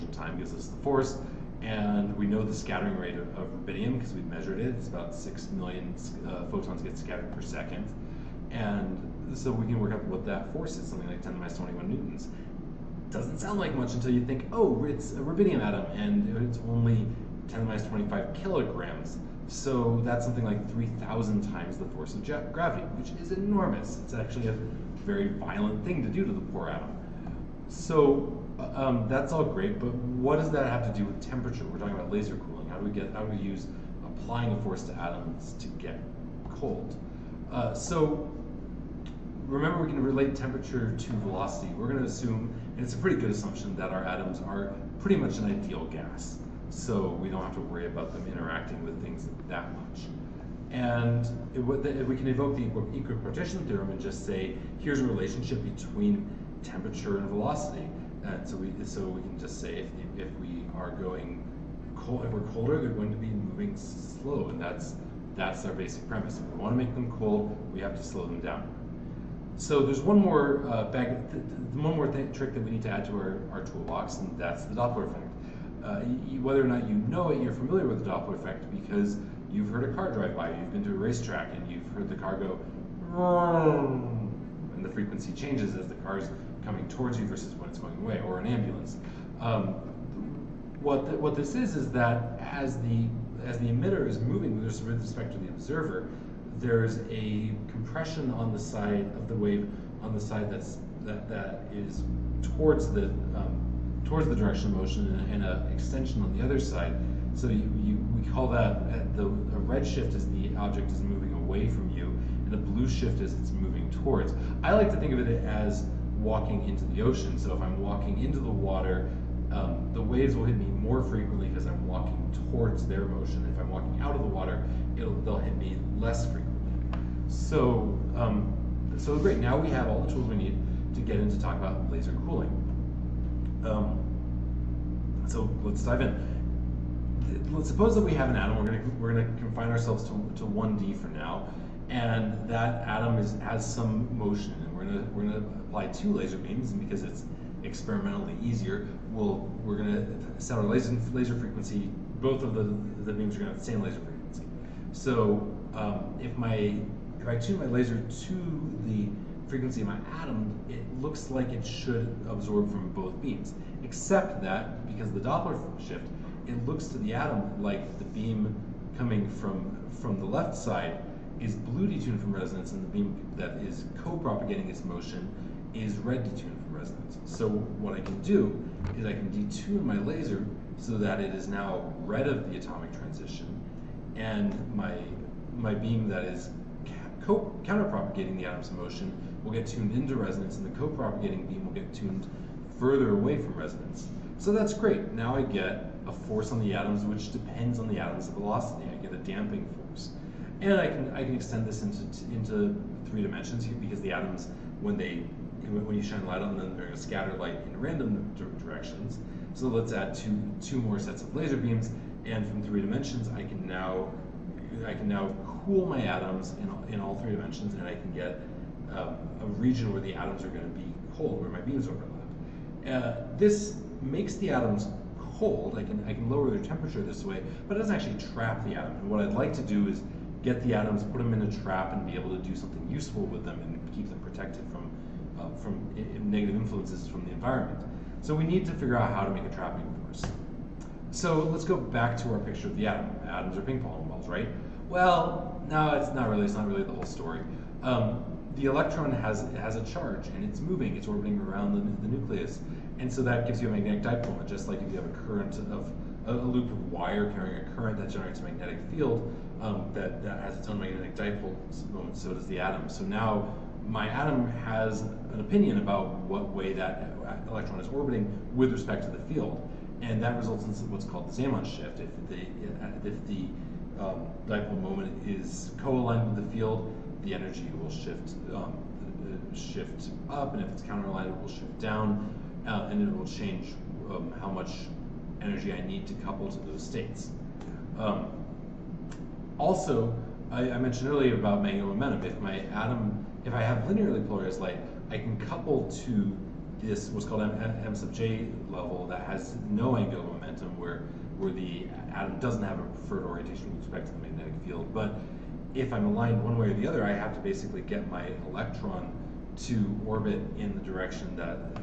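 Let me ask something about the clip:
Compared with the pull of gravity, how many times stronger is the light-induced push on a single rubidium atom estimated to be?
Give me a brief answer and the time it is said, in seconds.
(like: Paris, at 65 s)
3,000, at 20 s.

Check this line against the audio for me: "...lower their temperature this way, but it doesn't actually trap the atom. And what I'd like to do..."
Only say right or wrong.
right.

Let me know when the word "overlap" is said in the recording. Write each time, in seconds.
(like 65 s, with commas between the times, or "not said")
221 s.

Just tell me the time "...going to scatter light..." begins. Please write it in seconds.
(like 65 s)
206 s.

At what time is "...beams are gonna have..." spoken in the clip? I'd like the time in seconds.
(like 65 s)
153 s.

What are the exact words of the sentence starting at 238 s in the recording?
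So we need to figure out how to make a trapping force.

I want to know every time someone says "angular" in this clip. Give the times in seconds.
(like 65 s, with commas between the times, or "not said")
299 s.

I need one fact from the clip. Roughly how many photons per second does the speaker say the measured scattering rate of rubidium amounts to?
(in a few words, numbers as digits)
6 million.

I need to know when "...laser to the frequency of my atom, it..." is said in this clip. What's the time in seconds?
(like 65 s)
157 s.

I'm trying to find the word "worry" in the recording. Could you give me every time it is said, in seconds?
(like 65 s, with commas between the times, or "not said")
47 s.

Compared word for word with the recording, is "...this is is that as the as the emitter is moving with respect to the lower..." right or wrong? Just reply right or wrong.
wrong.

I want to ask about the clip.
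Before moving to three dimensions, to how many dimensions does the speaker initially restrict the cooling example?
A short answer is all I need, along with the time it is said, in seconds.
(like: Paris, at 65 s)
1D, at 140 s.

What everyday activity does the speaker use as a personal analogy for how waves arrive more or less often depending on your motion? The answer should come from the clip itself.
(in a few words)
walking into the ocean.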